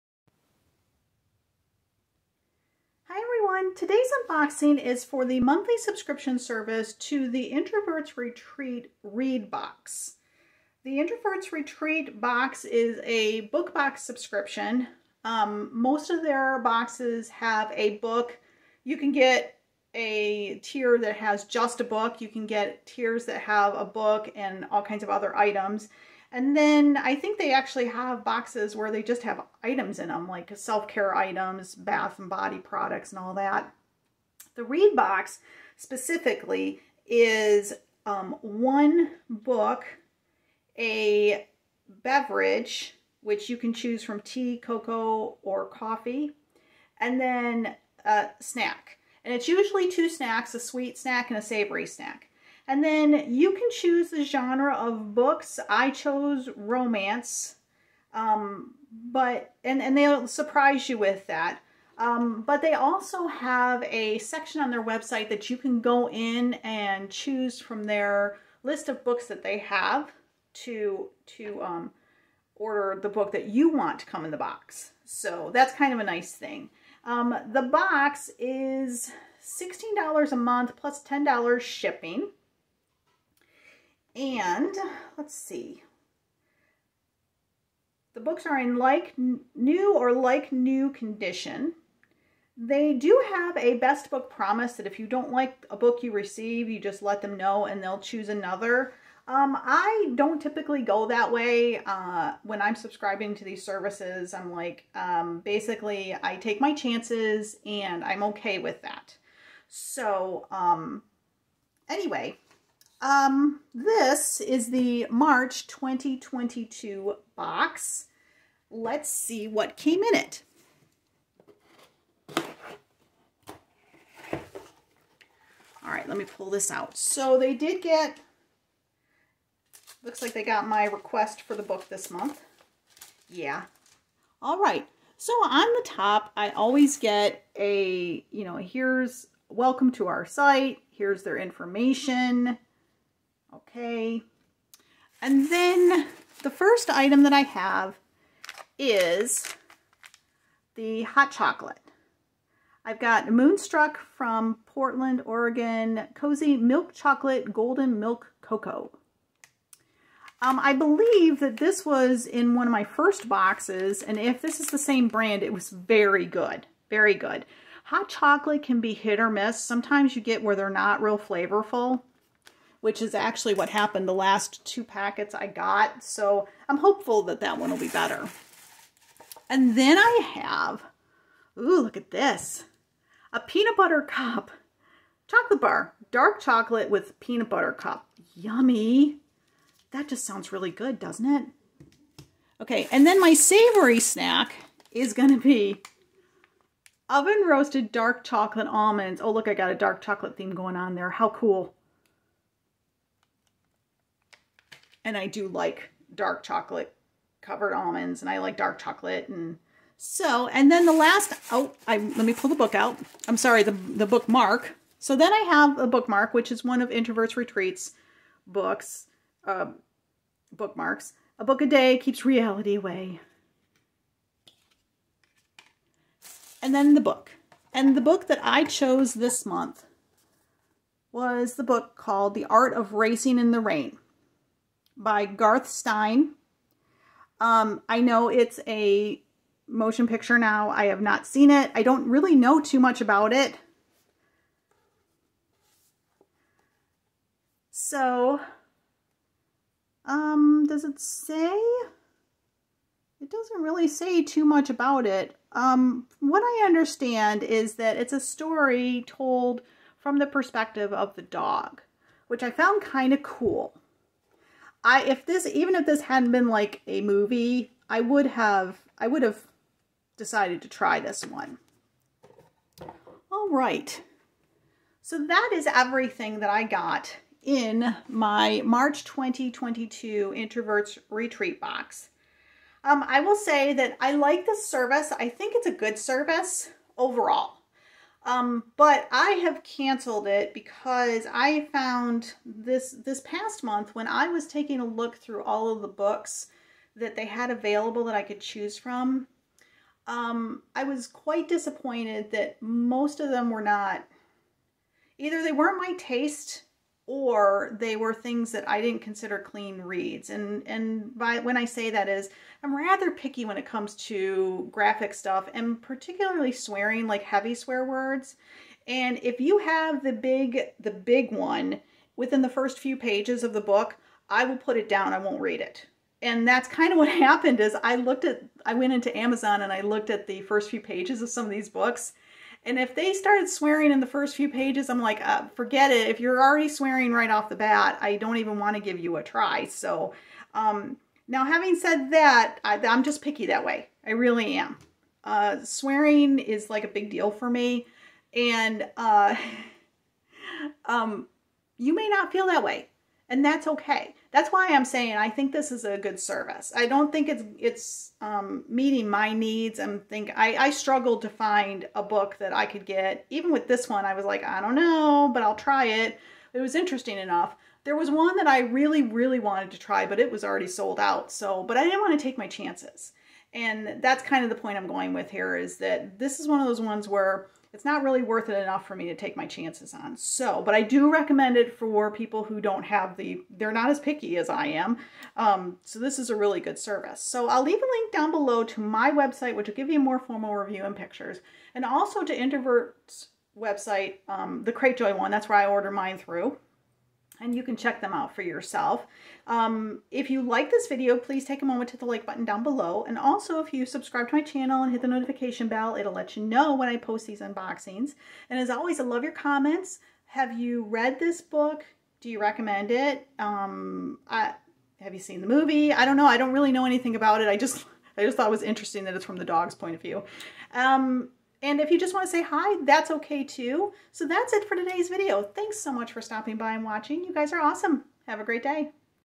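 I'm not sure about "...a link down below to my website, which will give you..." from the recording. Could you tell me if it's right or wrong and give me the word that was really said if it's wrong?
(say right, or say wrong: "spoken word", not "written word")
right.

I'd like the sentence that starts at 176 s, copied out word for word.
So I'm hopeful that that one will be better.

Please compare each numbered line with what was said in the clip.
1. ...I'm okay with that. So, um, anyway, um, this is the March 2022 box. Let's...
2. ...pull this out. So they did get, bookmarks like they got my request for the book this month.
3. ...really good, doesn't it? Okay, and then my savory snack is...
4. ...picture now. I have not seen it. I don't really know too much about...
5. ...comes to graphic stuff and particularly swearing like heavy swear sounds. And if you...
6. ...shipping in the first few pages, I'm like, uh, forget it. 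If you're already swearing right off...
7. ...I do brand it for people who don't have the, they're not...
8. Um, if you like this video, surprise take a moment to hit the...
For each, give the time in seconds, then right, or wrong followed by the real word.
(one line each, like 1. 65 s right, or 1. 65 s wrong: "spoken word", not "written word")
1. 108 s right
2. 126 s wrong: "looks", not "bookmarks"
3. 190 s right
4. 240 s right
5. 313 s wrong: "words", not "sounds"
6. 333 s wrong: "swearing", not "shipping"
7. 380 s wrong: "recommend", not "brand"
8. 399 s wrong: "please", not "surprise".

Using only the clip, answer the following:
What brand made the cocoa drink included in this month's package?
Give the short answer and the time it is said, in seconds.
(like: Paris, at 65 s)
Moonstruck, at 153 s.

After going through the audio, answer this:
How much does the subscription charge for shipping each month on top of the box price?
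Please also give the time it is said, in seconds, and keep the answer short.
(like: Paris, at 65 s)
$10, at 81 s.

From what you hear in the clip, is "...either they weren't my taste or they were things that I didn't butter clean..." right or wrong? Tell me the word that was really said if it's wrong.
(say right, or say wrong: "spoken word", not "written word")
wrong: "consider", not "butter".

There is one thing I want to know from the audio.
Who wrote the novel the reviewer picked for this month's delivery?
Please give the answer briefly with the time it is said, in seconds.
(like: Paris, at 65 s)
Garth Stein, at 235 s.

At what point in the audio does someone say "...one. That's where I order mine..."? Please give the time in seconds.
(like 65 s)
395 s.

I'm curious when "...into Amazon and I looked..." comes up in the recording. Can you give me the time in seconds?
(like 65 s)
328 s.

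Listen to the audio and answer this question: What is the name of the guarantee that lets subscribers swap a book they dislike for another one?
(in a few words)
best book promise.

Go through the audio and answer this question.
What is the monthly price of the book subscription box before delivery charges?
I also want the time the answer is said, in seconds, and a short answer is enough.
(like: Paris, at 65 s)
$16, at 79 s.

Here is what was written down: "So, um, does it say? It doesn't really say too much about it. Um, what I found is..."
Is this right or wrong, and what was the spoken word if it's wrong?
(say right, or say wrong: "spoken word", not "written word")
wrong: "understand", not "found".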